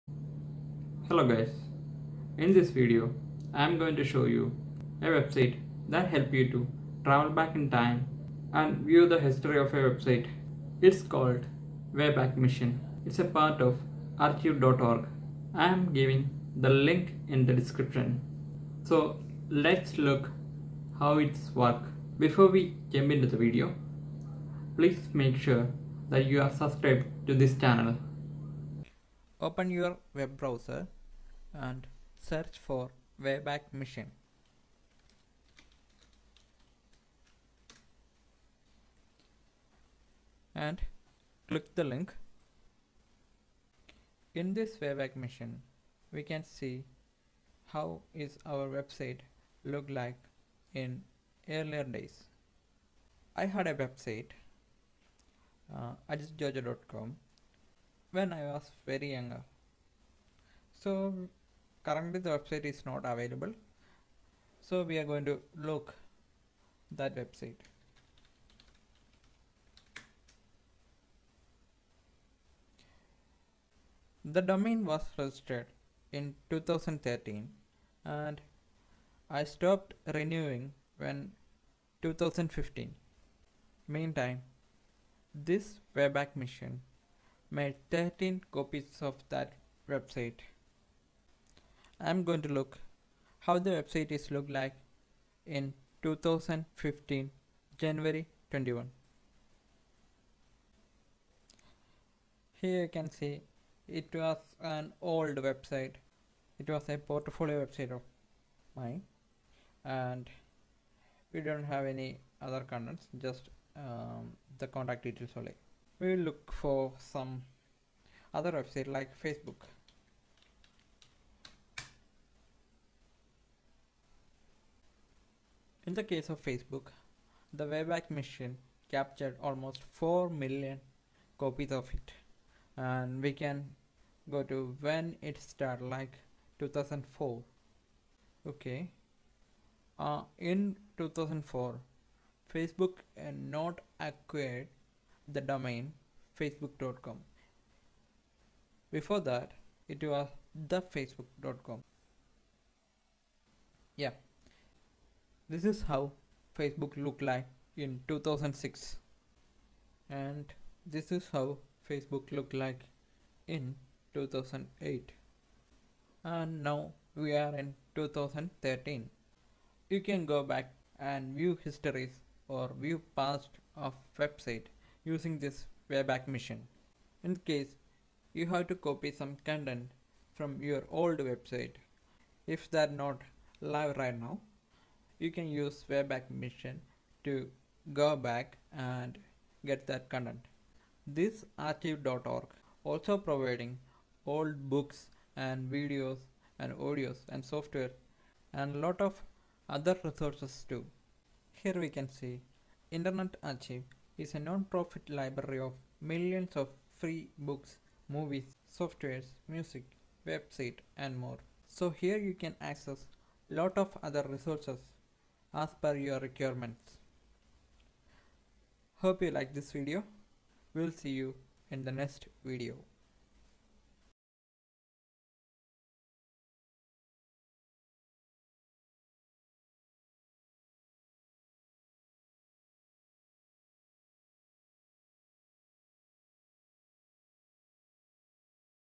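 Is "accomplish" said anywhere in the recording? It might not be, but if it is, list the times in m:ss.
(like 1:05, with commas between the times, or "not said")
not said.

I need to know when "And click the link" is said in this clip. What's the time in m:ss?
0:40.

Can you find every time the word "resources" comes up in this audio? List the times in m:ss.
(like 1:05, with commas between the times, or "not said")
3:20, 3:34.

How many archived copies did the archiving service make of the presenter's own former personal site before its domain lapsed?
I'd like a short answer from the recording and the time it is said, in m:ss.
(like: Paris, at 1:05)
13, at 1:27.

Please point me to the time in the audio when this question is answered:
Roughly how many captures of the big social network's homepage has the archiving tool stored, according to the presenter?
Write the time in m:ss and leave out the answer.
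2:09.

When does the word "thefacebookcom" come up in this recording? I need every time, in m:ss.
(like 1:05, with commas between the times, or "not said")
2:30.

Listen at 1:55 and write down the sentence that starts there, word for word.
We will look for some other website like Facebook.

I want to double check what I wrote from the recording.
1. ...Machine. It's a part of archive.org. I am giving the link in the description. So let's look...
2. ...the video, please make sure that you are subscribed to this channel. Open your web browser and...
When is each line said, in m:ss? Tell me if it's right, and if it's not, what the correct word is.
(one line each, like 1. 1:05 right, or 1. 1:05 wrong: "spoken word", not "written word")
1. 0:12 right
2. 0:23 right.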